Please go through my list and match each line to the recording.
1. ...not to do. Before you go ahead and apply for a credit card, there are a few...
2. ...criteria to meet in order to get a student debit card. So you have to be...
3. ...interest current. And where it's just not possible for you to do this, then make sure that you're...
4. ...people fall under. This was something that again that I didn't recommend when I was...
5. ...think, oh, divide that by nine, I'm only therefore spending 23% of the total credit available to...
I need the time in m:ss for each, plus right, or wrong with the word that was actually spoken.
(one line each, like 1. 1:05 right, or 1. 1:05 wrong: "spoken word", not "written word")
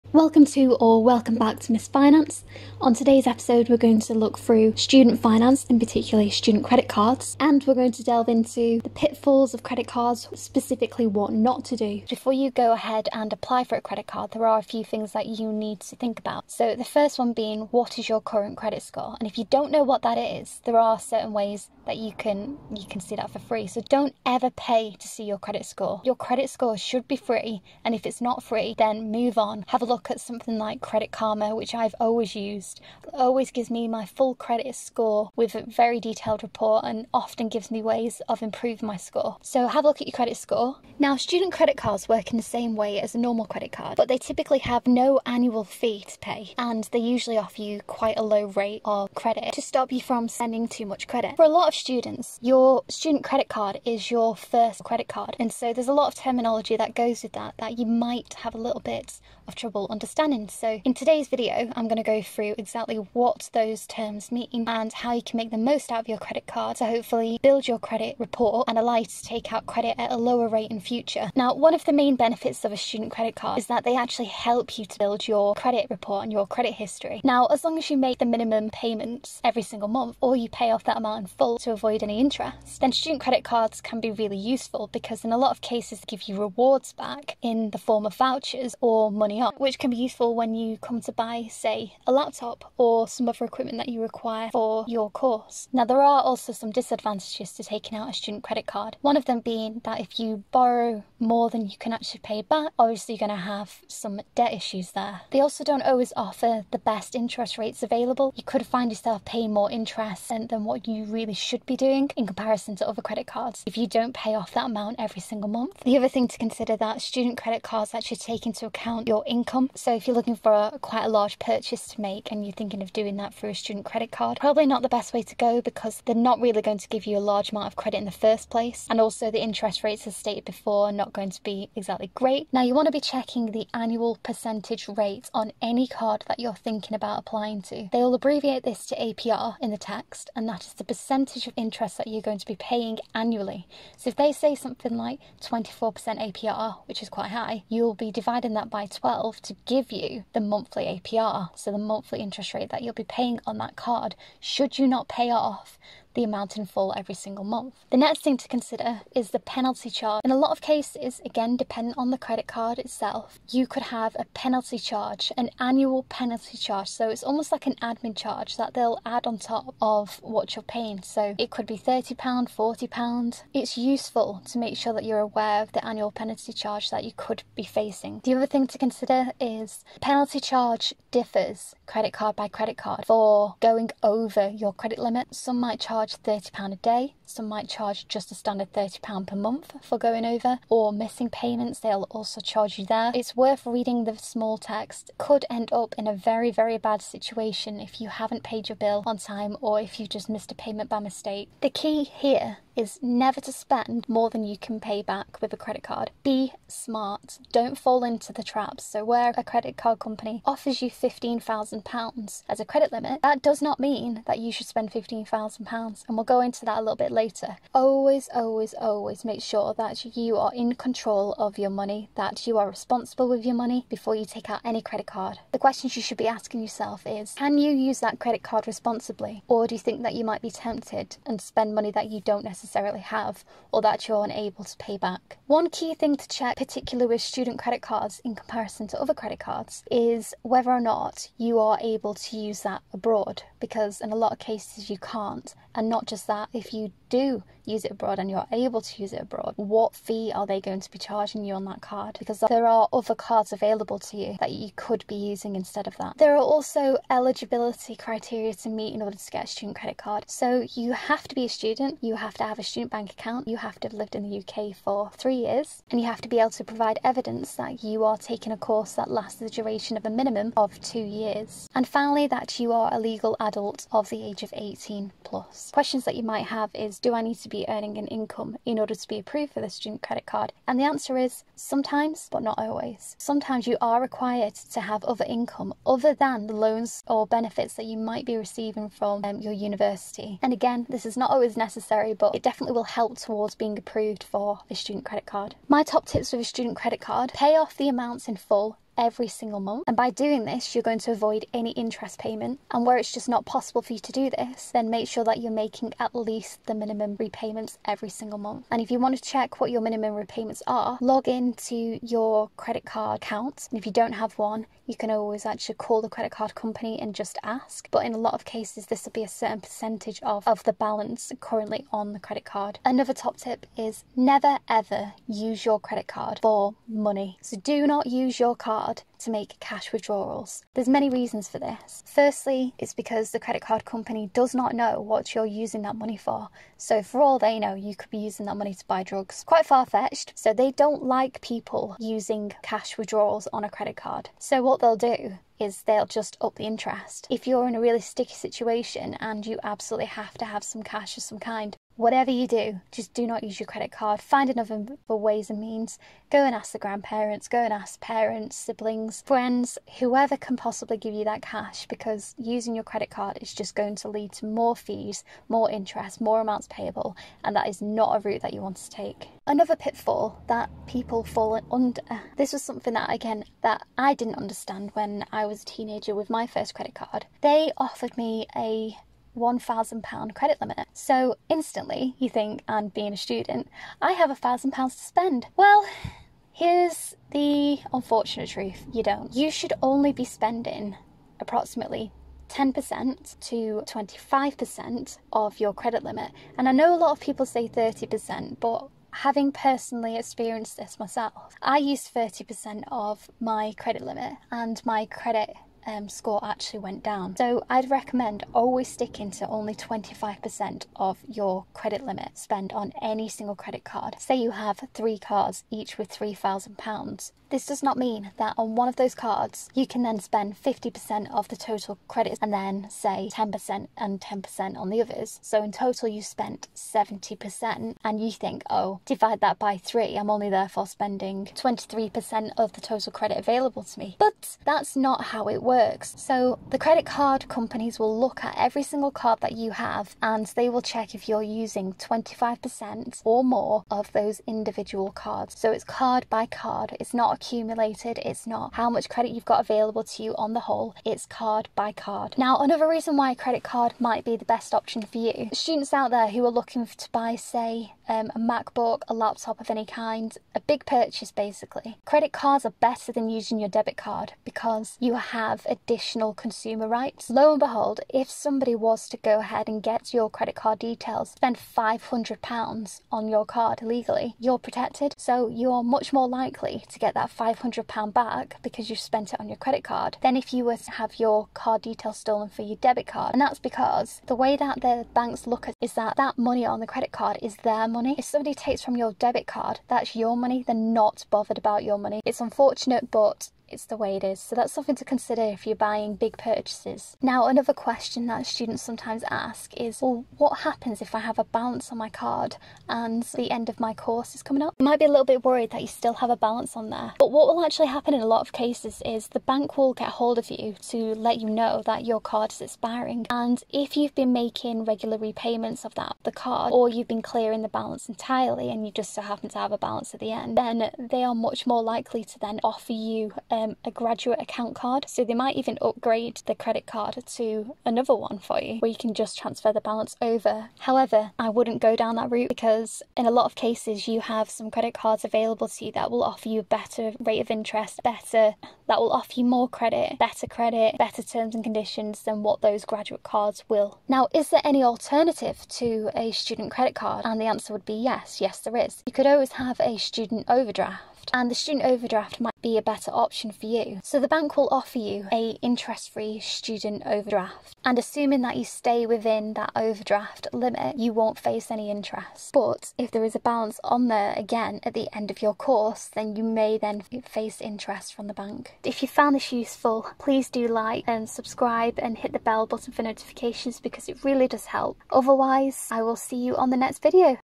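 1. 0:11 right
2. 4:17 wrong: "credit", not "debit"
3. 5:01 wrong: "payment", not "current"
4. 6:10 wrong: "understand", not "recommend"
5. 7:08 wrong: "three", not "nine".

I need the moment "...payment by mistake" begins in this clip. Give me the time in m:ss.
3:20.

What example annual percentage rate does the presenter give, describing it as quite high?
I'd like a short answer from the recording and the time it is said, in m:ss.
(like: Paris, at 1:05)
24%, at 2:25.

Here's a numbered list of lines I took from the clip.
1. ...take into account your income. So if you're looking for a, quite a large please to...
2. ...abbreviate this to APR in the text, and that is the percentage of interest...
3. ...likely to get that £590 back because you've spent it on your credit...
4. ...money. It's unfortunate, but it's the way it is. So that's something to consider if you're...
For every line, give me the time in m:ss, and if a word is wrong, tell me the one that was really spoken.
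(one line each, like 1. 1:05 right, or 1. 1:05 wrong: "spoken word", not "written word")
1. 1:58 wrong: "purchase", not "please"
2. 2:18 right
3. 7:56 wrong: "500", not "590"
4. 8:11 right.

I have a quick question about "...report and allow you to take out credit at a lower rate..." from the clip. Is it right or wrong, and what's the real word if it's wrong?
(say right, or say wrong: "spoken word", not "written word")
right.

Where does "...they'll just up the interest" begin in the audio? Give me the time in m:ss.
5:45.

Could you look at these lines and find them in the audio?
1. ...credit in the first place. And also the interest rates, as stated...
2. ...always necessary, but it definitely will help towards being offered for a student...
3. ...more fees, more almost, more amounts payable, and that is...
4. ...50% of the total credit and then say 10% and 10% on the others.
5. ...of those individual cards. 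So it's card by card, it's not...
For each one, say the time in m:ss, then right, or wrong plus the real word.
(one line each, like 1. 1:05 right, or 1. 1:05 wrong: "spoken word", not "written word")
1. 2:07 right
2. 4:51 wrong: "approved", not "offered"
3. 6:04 wrong: "interest", not "almost"
4. 7:00 right
5. 7:23 right.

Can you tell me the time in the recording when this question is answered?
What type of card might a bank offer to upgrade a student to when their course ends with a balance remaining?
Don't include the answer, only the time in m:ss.
8:43.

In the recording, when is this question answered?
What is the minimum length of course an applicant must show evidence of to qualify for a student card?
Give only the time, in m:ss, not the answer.
4:30.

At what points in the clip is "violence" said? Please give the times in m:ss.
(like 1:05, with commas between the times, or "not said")
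not said.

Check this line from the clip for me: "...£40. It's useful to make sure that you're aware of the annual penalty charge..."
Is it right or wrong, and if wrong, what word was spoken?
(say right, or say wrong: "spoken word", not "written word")
right.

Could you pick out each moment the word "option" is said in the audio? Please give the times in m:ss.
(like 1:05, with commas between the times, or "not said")
7:34, 9:13.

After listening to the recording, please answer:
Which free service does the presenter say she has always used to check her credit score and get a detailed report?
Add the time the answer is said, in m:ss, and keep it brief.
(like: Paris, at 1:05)
Credit Karma, at 0:30.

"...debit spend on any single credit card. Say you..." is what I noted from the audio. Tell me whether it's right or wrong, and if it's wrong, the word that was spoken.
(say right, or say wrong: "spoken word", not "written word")
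wrong: "limit", not "debit".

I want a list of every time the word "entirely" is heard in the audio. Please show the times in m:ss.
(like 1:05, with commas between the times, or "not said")
8:38.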